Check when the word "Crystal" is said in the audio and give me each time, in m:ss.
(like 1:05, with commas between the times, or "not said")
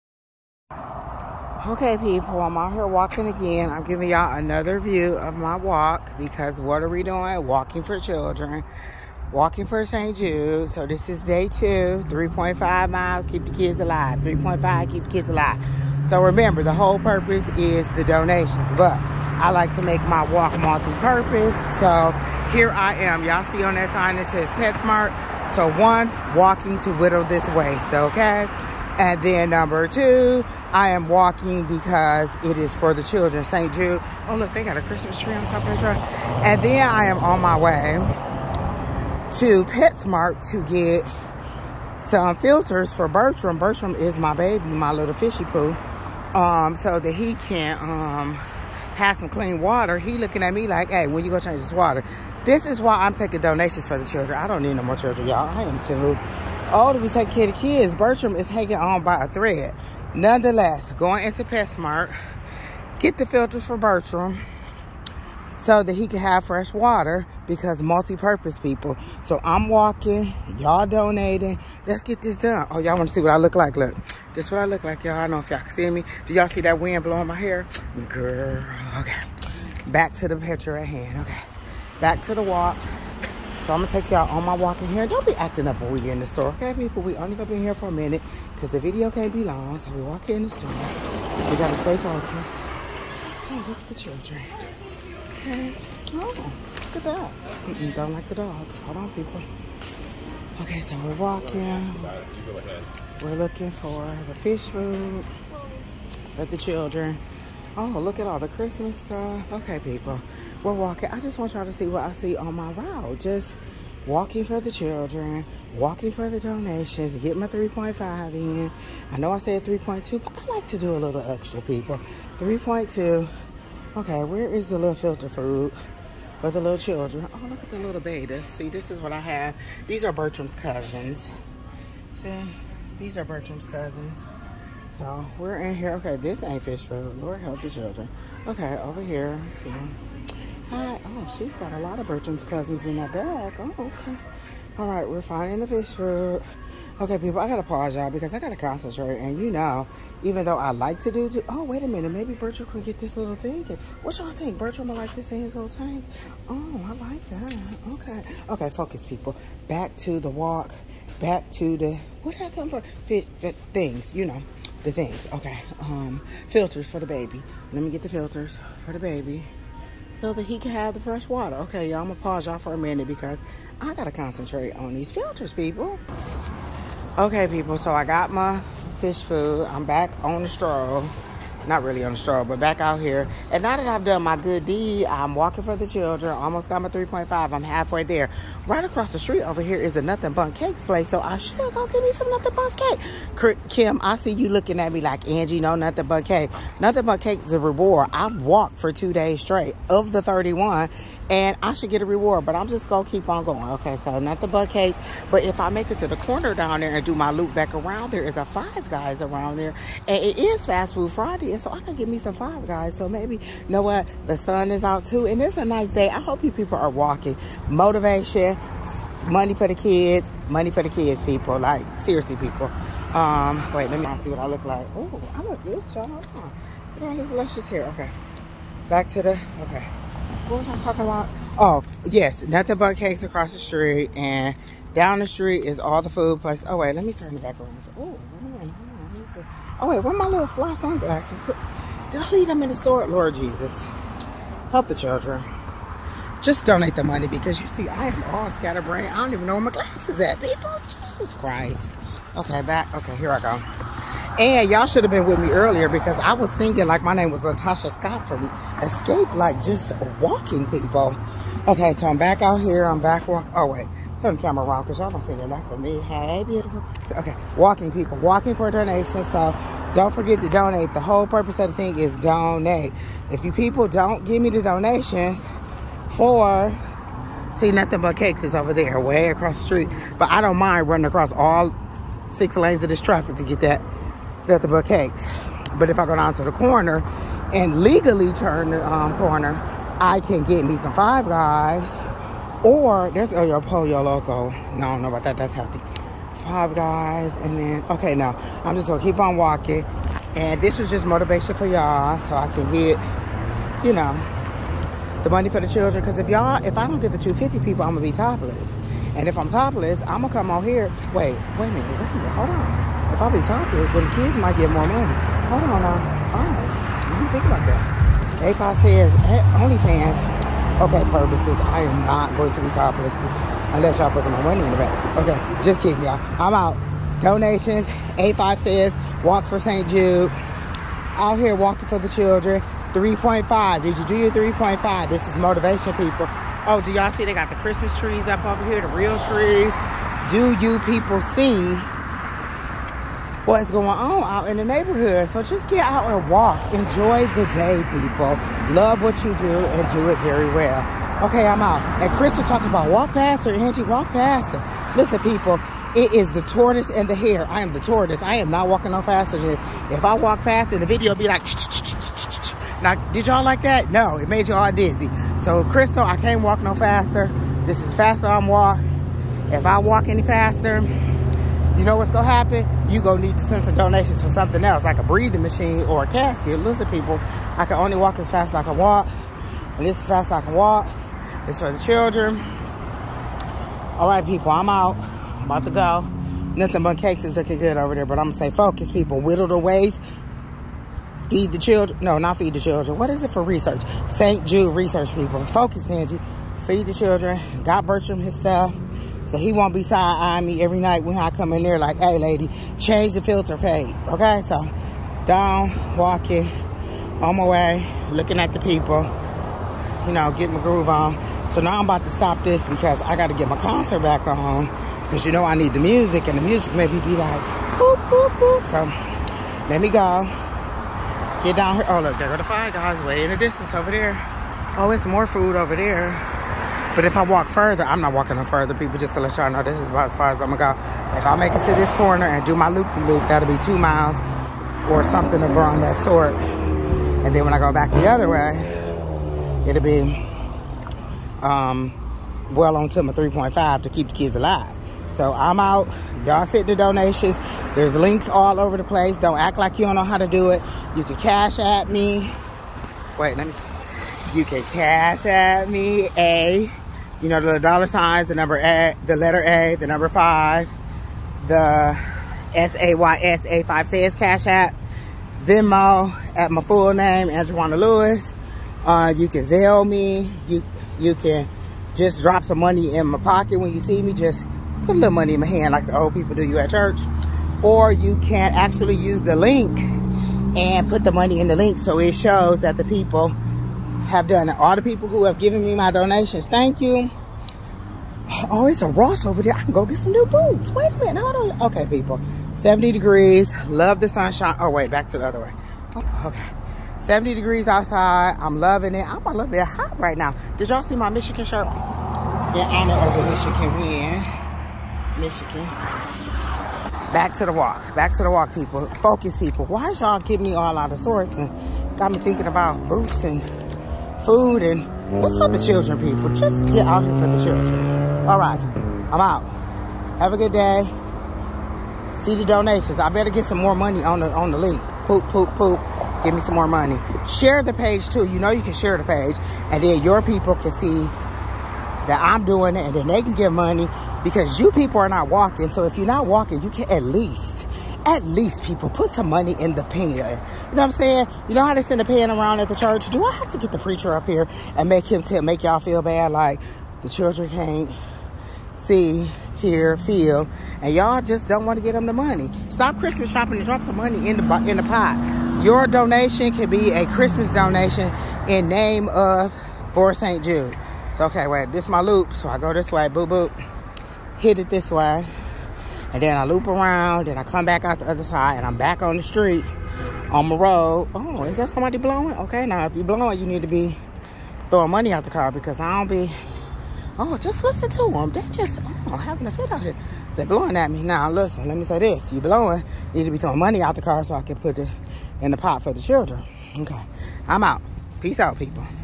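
5:52, 6:05.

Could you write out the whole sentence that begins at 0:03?
I'm giving y'all another view of my walk because what are we doing?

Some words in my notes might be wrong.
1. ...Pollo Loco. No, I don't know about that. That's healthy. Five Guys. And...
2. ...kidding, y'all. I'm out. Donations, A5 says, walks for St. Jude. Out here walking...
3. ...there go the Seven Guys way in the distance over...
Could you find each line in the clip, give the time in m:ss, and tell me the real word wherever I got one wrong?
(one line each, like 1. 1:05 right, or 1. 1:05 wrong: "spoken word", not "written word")
1. 4:53 right
2. 5:25 right
3. 7:02 wrong: "Five", not "Seven".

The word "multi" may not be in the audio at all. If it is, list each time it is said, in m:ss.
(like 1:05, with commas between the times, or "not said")
0:20, 1:07.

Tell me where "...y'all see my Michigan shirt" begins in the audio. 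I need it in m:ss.
8:20.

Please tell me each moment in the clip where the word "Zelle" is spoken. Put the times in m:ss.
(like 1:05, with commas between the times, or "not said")
7:49.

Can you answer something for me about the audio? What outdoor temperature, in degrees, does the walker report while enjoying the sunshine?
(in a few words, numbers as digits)
70.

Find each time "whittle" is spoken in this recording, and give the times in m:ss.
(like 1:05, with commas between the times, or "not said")
0:26, 6:29.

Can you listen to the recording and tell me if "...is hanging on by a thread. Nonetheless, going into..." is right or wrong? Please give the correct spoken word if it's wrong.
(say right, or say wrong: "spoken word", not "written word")
right.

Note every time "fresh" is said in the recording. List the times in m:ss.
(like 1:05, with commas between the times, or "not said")
1:06, 2:50.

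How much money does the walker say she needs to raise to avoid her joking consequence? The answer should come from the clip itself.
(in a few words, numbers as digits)
250.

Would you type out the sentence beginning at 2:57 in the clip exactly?
Okay, people, so I got my fish food.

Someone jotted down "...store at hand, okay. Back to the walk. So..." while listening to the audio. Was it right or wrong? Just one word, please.
wrong.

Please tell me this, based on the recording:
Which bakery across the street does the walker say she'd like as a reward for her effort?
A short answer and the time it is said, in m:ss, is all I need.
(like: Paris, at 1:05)
Nothing Bundt Cakes, at 3:10.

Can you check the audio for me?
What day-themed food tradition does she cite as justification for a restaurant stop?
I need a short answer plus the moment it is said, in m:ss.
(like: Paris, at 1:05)
Fast Food Friday, at 3:30.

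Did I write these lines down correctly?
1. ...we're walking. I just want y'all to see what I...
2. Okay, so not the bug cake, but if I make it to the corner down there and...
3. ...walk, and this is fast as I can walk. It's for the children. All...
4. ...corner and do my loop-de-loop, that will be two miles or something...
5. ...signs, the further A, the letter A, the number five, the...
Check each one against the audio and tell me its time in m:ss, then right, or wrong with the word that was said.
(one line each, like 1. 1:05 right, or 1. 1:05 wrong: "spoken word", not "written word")
1. 1:50 right
2. 3:23 right
3. 6:18 right
4. 7:11 right
5. 7:37 wrong: "number", not "further".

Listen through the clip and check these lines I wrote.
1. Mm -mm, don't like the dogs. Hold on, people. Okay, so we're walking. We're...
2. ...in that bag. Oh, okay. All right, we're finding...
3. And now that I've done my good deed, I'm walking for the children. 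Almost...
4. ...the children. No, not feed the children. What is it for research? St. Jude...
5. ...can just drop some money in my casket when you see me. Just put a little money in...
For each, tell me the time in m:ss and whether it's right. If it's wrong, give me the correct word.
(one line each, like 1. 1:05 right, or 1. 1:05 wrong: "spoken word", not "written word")
1. 1:37 right
2. 2:22 right
3. 3:03 right
4. 6:31 right
5. 7:51 wrong: "pocket", not "casket".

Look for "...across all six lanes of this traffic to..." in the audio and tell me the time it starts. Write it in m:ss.
4:41.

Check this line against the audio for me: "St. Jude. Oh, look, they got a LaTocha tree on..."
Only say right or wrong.
wrong.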